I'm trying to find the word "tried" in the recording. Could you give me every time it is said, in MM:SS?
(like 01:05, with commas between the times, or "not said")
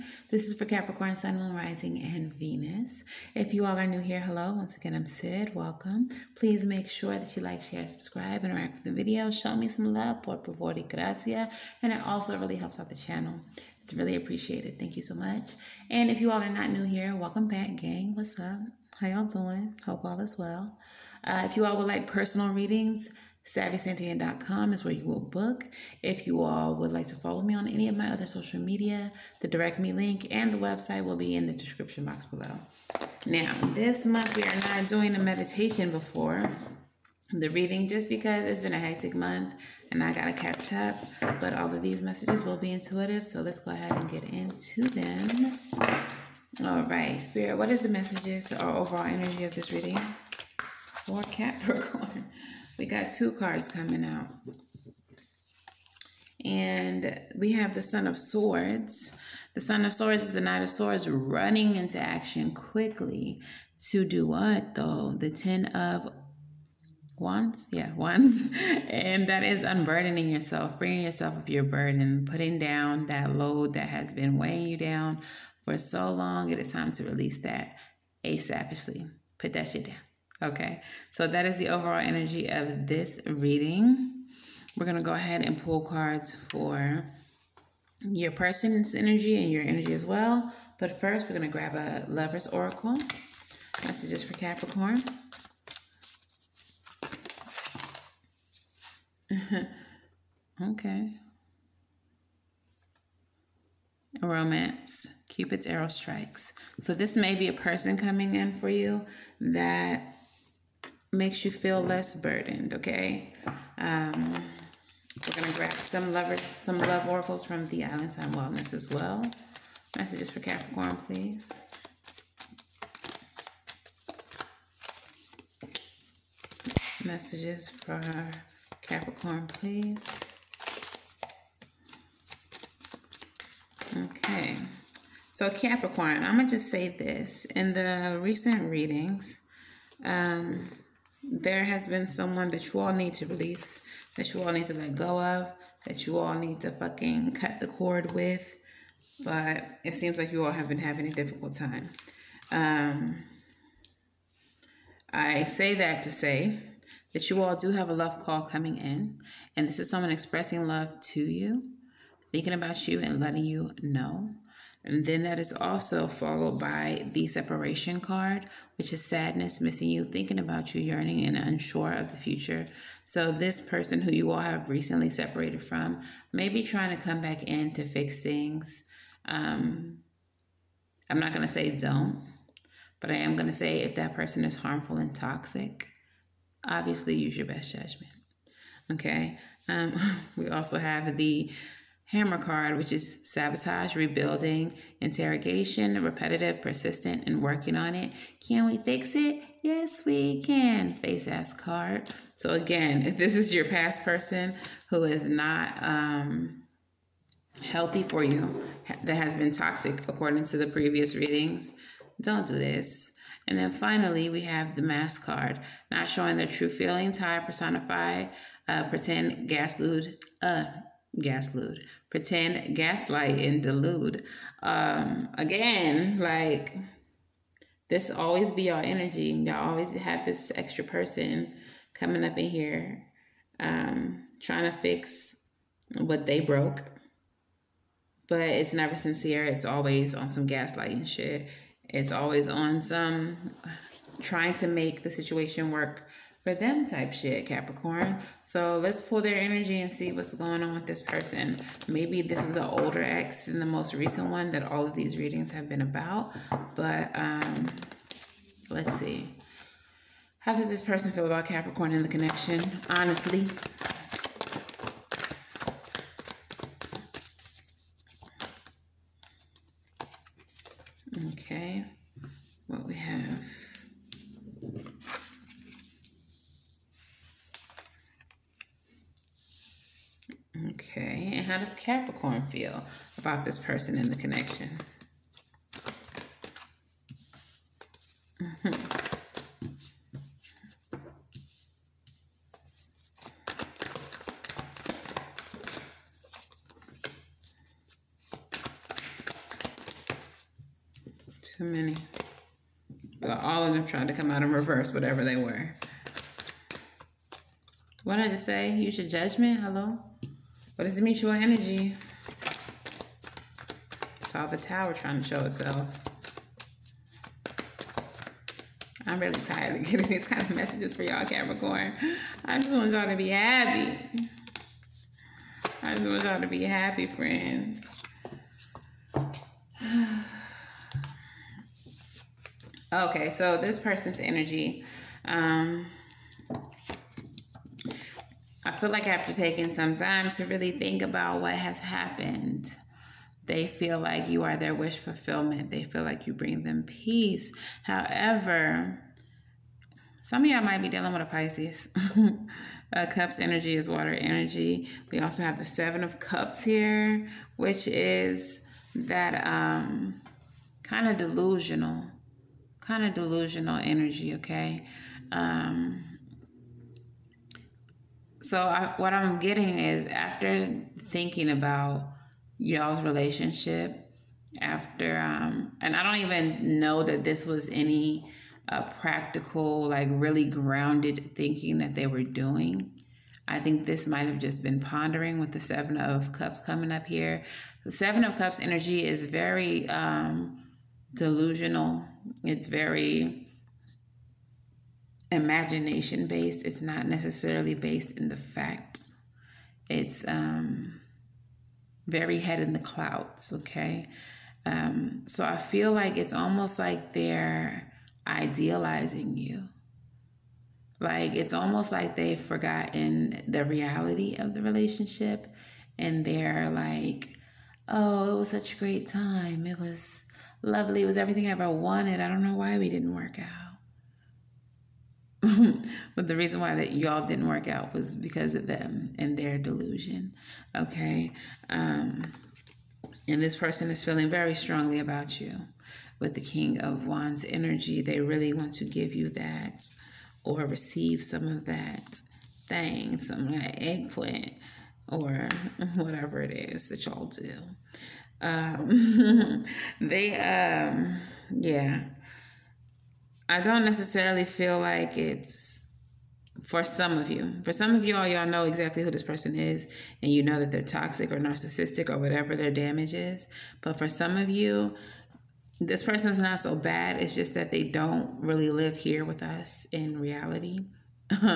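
05:03.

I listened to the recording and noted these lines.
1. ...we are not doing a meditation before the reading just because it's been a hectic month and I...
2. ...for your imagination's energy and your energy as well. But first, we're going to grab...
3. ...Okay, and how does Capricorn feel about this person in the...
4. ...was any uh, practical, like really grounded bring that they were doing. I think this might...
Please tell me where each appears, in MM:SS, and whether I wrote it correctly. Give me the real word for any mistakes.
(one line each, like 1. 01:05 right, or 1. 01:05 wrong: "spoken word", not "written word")
1. 00:34 right
2. 01:26 wrong: "person", not "imagination"
3. 04:40 right
4. 06:17 wrong: "thinking", not "bring".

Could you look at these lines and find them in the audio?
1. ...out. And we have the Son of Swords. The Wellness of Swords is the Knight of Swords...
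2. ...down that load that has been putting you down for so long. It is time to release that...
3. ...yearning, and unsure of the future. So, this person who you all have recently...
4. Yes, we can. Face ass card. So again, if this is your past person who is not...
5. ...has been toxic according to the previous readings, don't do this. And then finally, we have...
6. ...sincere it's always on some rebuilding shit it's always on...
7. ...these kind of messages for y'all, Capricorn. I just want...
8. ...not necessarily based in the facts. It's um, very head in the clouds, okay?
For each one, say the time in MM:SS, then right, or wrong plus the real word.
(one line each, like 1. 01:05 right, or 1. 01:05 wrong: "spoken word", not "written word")
1. 00:54 wrong: "Son", not "Wellness"
2. 01:12 wrong: "weighing", not "putting"
3. 02:50 right
4. 03:19 right
5. 03:29 right
6. 03:58 wrong: "gaslighting", not "rebuilding"
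7. 05:20 right
8. 06:36 right.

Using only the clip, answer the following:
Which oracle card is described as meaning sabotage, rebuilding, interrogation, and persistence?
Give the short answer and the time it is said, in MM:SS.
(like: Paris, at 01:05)
hammer card, at 03:12.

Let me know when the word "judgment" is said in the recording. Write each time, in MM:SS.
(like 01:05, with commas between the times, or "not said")
03:07, 05:09.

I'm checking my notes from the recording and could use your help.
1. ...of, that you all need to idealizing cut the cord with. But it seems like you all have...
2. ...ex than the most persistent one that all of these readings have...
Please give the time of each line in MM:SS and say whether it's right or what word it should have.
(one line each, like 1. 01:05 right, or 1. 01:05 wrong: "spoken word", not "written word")
1. 02:25 wrong: "fucking", not "idealizing"
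2. 04:13 wrong: "recent", not "persistent".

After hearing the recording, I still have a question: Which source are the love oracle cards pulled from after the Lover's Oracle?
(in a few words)
Island Time Wellness.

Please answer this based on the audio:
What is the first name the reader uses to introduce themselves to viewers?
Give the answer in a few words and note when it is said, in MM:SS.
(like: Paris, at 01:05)
Sid, at 00:04.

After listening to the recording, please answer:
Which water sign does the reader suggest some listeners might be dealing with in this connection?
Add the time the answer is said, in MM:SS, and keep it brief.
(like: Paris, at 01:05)
Pisces, at 05:51.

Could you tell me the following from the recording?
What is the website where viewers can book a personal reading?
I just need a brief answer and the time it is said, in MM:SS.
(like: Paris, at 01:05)
savysentient.com, at 00:23.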